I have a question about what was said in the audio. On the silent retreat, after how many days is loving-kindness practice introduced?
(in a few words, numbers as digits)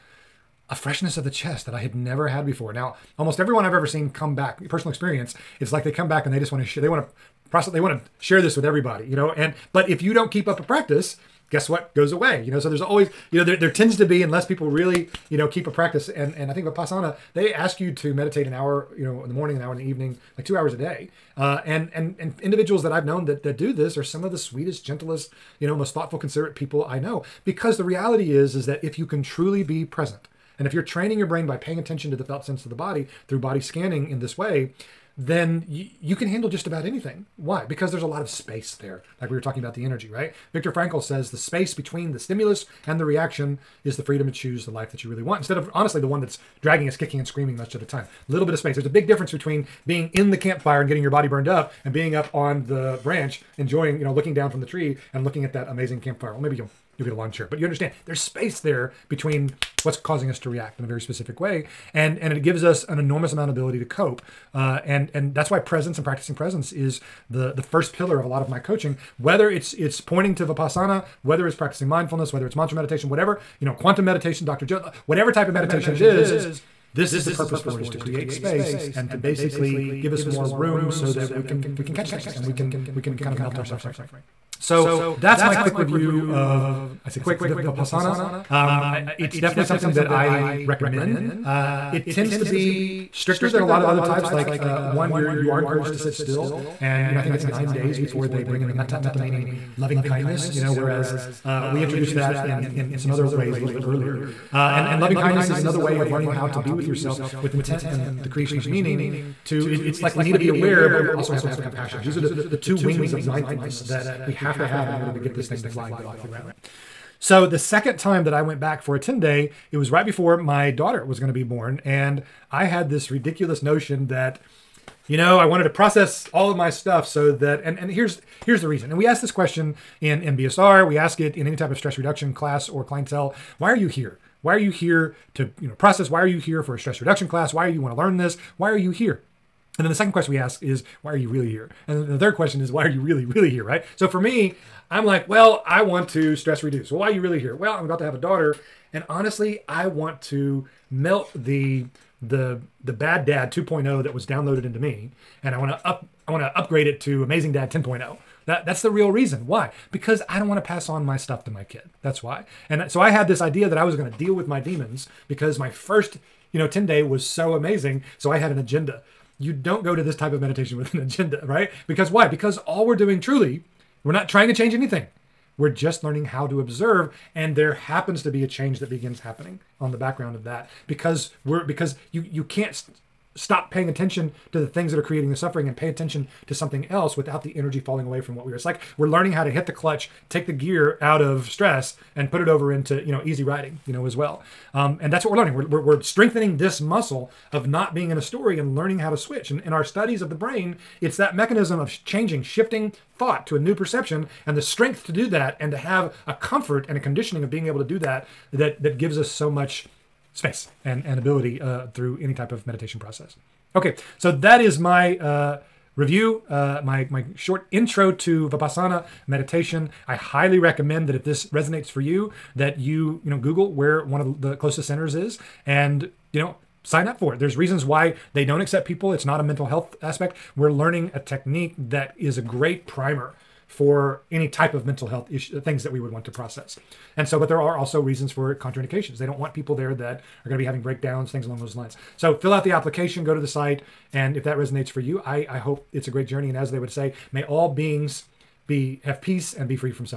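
9 days.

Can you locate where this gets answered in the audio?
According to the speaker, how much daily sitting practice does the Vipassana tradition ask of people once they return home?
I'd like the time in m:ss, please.
0:20.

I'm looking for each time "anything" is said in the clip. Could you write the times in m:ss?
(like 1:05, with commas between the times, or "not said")
0:36, 2:54.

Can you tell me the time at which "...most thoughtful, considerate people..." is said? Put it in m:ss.
0:25.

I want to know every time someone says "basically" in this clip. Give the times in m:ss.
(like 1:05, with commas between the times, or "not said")
1:19.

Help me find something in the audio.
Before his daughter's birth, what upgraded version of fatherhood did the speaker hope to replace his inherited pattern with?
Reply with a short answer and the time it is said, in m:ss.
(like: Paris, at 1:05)
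amazing dad 10.0, at 2:37.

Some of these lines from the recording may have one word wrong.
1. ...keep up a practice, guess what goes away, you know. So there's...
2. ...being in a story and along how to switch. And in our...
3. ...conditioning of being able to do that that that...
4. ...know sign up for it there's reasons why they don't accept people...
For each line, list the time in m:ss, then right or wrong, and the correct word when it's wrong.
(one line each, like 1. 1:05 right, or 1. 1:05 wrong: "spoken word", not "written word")
1. 0:10 right
2. 3:17 wrong: "learning", not "along"
3. 3:26 right
4. 3:46 right.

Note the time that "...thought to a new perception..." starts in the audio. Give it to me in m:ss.
3:23.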